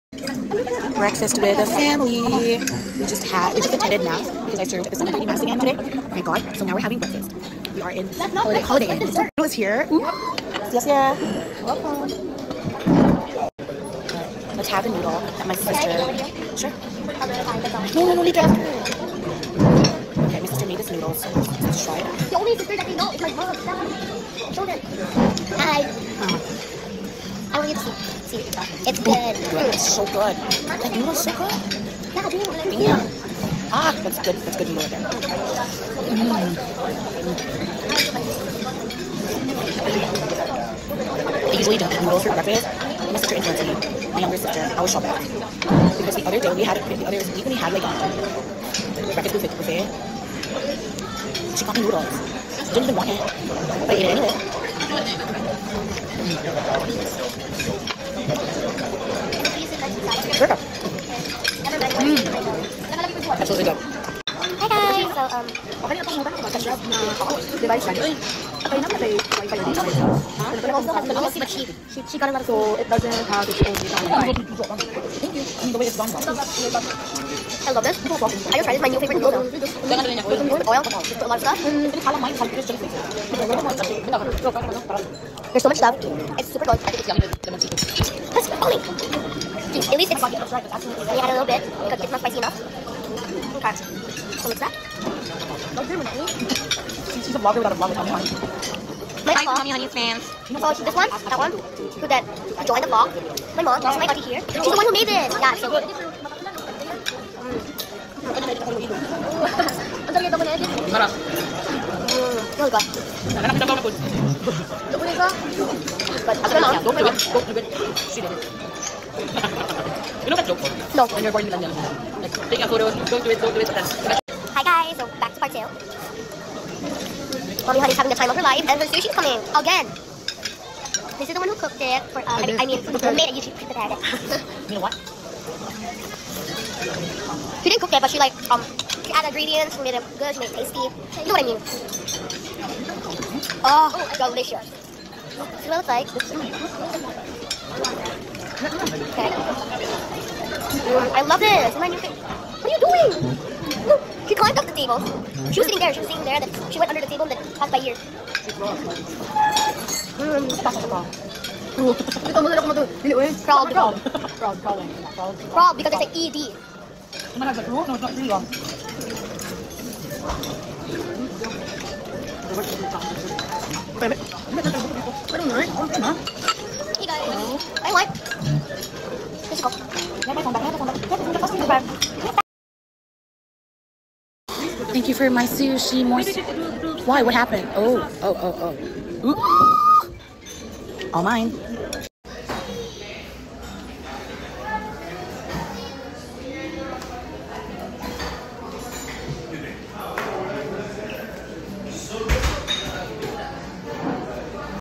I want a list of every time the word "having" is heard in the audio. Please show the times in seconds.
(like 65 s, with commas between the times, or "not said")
6 s, 127 s.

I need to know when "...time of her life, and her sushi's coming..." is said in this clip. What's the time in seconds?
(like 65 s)
128 s.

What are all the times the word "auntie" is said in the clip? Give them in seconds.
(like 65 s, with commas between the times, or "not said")
104 s.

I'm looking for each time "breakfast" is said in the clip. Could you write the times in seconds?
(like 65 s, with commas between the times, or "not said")
0 s, 6 s, 42 s, 49 s.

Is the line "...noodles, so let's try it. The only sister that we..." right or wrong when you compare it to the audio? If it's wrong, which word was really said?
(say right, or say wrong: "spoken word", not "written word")
right.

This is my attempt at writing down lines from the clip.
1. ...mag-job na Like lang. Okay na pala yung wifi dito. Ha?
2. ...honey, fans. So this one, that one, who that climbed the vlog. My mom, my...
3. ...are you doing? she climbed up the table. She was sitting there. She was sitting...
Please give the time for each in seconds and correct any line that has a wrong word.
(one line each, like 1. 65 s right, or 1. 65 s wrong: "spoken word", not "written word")
1. 66 s wrong: "Device", not "Like"
2. 99 s wrong: "joined", not "climbed"
3. 151 s right.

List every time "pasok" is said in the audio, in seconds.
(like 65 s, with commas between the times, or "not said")
160 s.